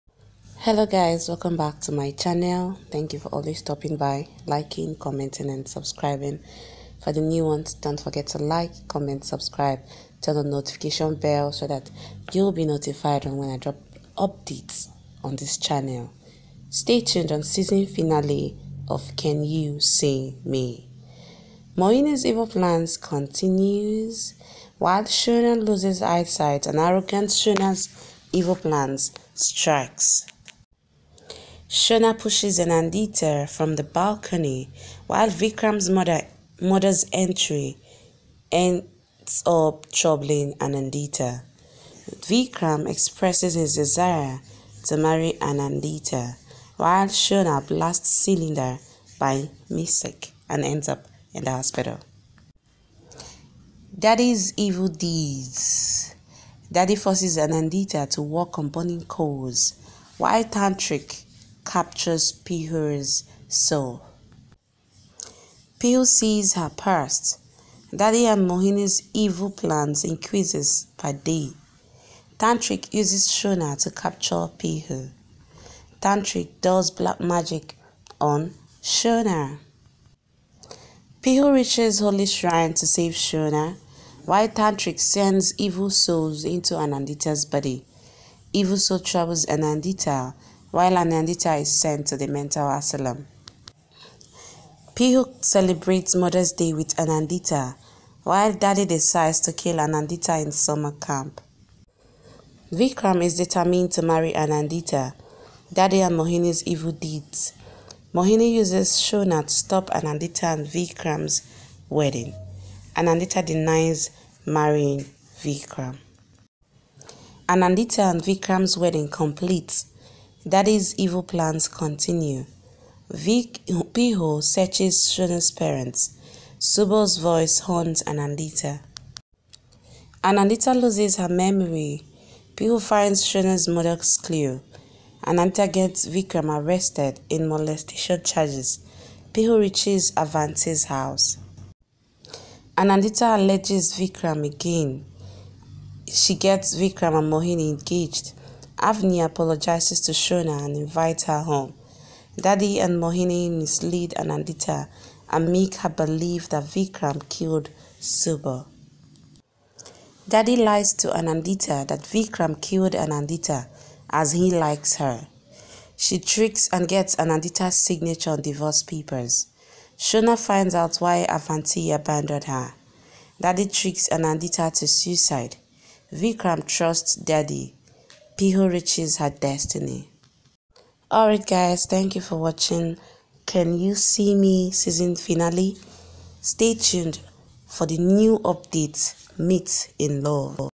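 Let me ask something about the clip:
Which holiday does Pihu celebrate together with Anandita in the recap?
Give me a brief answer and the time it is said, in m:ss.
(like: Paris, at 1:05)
Mother's Day, at 1:36.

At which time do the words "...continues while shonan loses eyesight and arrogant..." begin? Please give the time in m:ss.
0:22.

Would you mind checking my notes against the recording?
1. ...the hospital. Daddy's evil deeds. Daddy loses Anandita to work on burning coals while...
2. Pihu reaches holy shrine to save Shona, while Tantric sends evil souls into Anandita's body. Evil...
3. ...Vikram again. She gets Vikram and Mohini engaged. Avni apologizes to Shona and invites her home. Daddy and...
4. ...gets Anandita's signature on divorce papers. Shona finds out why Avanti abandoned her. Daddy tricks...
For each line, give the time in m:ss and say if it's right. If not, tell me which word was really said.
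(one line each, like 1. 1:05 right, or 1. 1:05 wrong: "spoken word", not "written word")
1. 0:51 wrong: "forces", not "loses"
2. 1:21 right
3. 2:23 right
4. 2:46 right.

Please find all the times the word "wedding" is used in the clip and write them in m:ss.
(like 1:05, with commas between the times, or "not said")
1:51, 1:58.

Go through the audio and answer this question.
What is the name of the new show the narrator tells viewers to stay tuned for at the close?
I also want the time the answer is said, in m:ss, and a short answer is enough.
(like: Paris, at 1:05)
Meet in Love, at 3:09.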